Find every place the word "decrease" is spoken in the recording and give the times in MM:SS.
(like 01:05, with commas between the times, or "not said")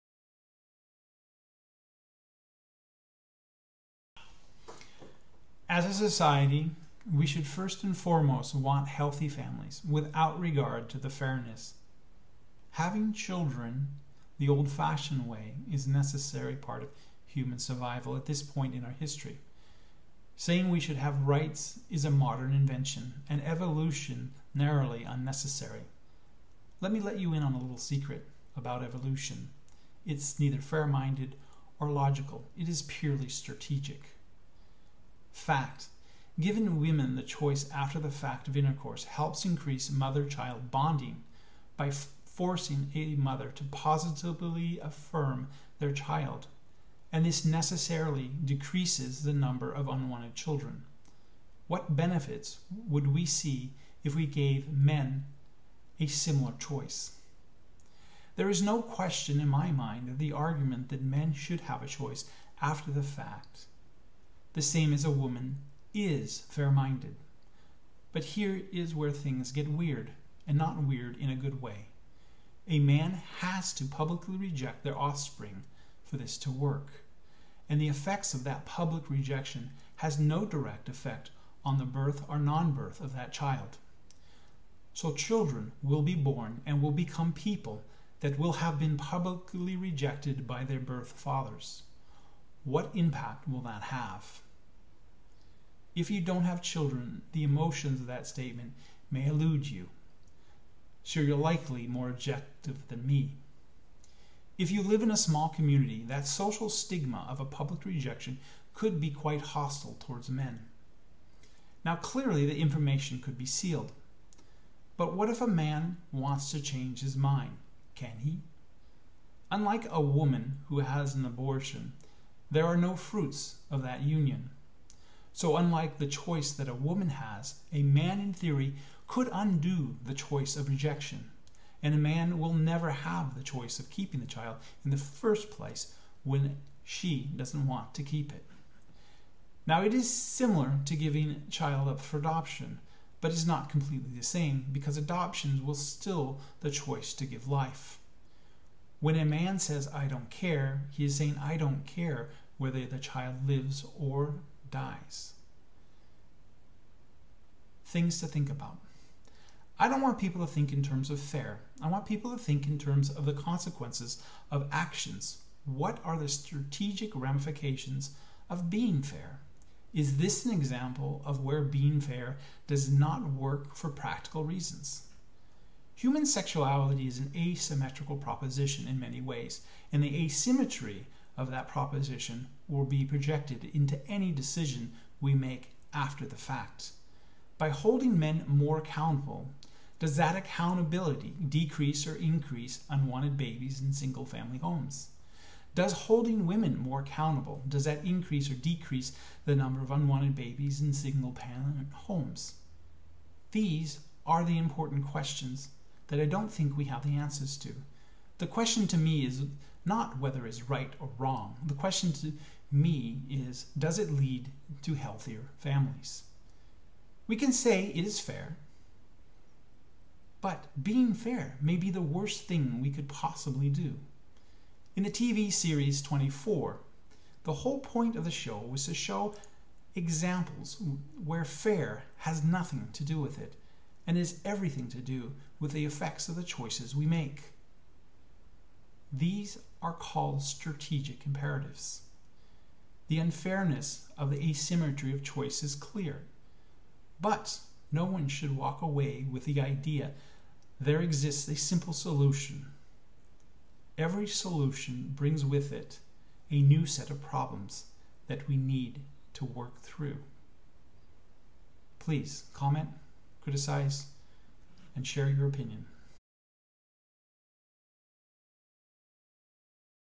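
00:48, 03:11, 03:18.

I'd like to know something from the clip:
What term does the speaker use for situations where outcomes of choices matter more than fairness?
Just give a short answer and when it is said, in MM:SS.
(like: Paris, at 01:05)
strategic imperatives, at 04:00.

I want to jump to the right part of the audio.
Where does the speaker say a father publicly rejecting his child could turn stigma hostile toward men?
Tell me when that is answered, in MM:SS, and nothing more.
01:45.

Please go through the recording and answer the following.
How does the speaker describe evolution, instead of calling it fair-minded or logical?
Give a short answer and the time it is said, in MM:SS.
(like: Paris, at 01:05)
purely strategic, at 00:32.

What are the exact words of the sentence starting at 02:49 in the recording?
Is this an example of where being fair does not work for practical reasons?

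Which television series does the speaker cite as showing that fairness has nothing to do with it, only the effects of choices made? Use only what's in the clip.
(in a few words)
24.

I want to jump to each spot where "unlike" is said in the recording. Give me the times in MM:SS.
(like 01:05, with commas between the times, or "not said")
01:59, 02:05.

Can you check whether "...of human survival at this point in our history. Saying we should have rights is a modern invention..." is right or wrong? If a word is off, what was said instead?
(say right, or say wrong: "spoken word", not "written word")
right.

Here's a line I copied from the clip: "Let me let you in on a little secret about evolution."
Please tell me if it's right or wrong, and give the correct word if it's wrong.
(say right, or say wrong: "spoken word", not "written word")
right.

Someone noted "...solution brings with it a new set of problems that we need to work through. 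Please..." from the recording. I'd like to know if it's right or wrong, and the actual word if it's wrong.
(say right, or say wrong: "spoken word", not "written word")
right.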